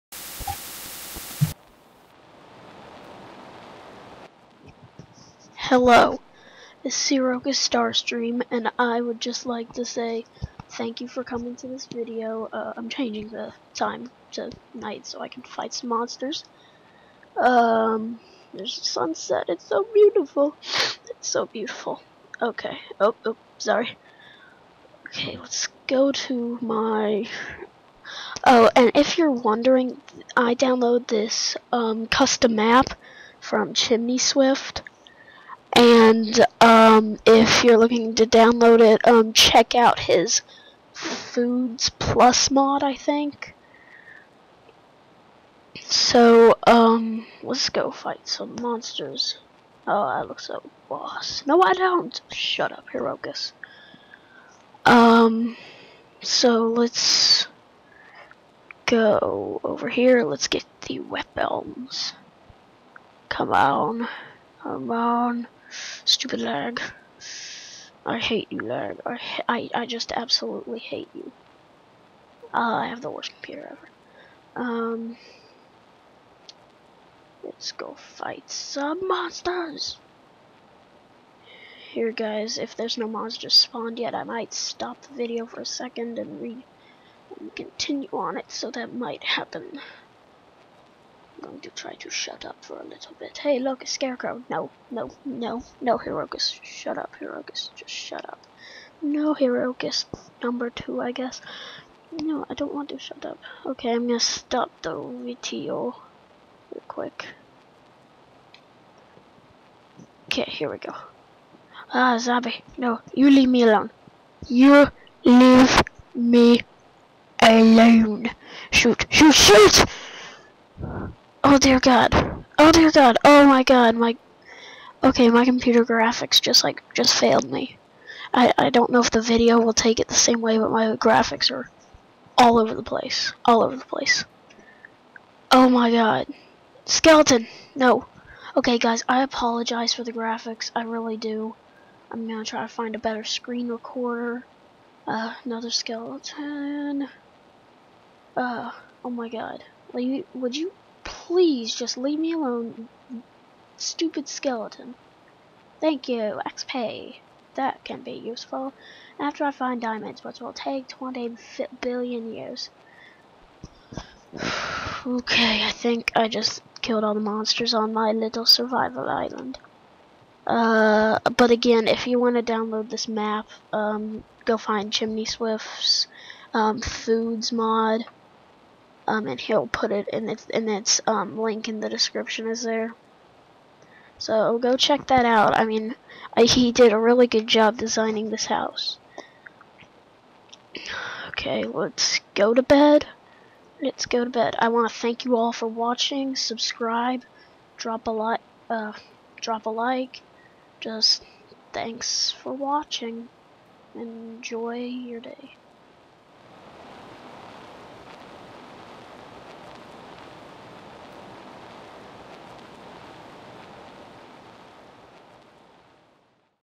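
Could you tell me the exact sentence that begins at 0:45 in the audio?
So, um, let's go fight some monsters.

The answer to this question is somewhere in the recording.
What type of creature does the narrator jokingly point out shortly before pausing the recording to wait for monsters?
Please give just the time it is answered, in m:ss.
1:33.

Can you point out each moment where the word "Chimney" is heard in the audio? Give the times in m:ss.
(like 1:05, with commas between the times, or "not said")
0:33, 2:54.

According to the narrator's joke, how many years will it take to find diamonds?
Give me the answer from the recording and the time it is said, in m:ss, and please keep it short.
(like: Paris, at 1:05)
20 billion years, at 2:40.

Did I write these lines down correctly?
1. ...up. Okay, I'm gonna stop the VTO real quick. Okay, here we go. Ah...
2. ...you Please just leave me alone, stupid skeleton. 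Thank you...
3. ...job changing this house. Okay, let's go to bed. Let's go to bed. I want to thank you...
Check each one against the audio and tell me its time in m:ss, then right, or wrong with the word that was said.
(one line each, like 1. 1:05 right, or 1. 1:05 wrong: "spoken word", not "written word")
1. 1:43 right
2. 2:30 right
3. 3:07 wrong: "designing", not "changing".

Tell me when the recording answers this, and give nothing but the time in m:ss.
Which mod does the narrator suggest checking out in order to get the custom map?
0:40.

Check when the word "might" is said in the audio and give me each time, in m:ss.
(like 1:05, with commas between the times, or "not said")
1:24, 1:28.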